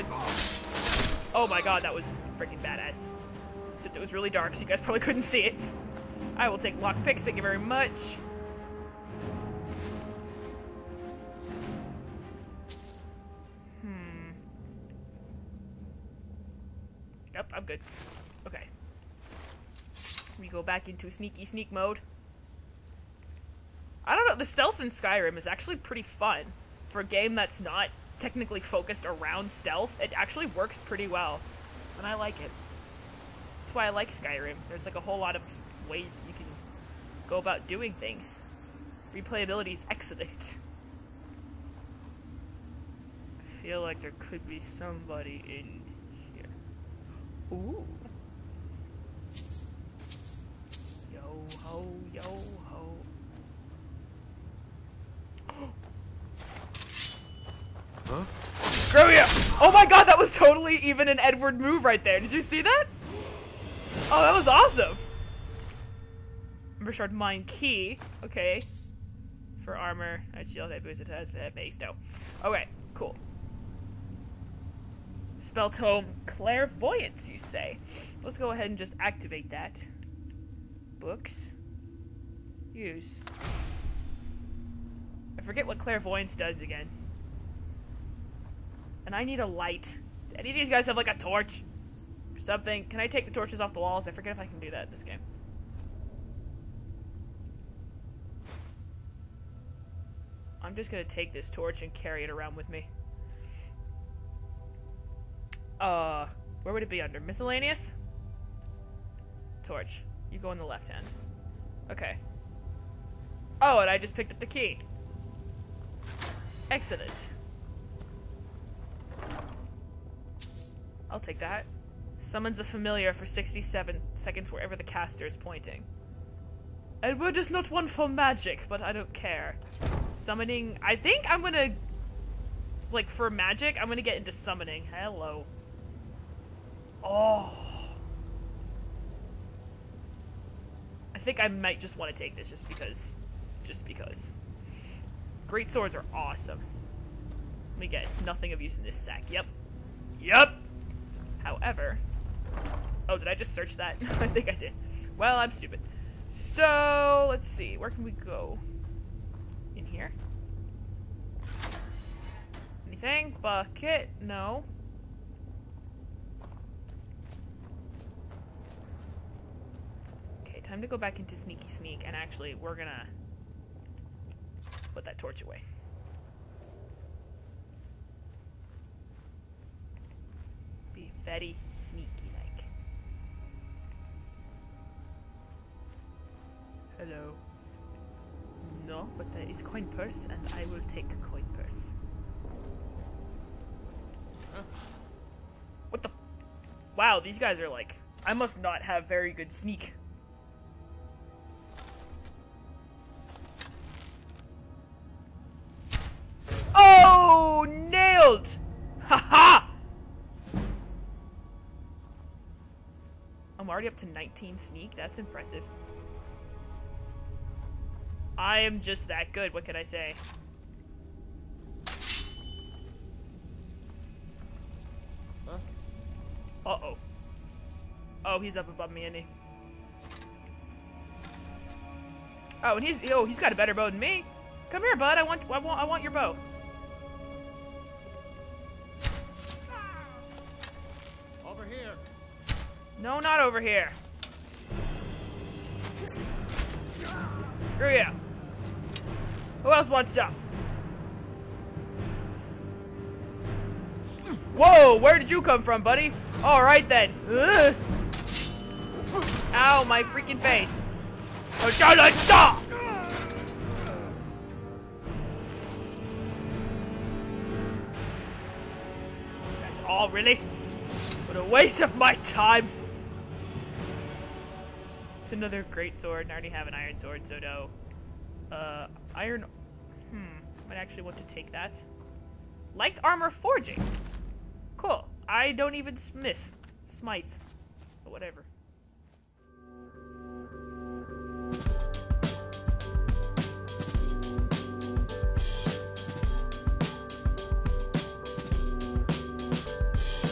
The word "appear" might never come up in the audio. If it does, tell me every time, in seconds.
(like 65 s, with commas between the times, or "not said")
not said.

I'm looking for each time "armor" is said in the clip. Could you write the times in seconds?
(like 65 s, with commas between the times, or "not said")
69 s, 283 s.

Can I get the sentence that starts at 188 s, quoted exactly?
No, but there is coin purse and I will take coin purse.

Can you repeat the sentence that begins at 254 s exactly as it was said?
Whoa, where did you come from, buddy?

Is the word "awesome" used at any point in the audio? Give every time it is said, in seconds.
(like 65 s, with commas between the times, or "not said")
64 s, 146 s.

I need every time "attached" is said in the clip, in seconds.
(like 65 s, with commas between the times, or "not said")
71 s.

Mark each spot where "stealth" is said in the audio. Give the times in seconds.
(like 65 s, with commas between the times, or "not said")
24 s, 29 s.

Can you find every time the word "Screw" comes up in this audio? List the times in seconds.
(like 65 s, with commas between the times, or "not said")
58 s, 247 s.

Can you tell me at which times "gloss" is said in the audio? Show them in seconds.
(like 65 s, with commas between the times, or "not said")
not said.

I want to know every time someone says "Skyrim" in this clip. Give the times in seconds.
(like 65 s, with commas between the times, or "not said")
24 s, 34 s.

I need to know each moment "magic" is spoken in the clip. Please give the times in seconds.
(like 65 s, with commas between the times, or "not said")
128 s, 133 s.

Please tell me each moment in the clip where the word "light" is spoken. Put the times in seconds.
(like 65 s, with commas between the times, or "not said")
89 s, 282 s.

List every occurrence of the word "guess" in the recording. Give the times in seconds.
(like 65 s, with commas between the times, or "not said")
147 s.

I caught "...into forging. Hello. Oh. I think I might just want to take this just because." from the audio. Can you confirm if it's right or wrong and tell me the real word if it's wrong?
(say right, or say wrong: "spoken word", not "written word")
wrong: "summoning", not "forging".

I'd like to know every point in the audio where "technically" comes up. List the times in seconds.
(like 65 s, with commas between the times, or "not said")
28 s.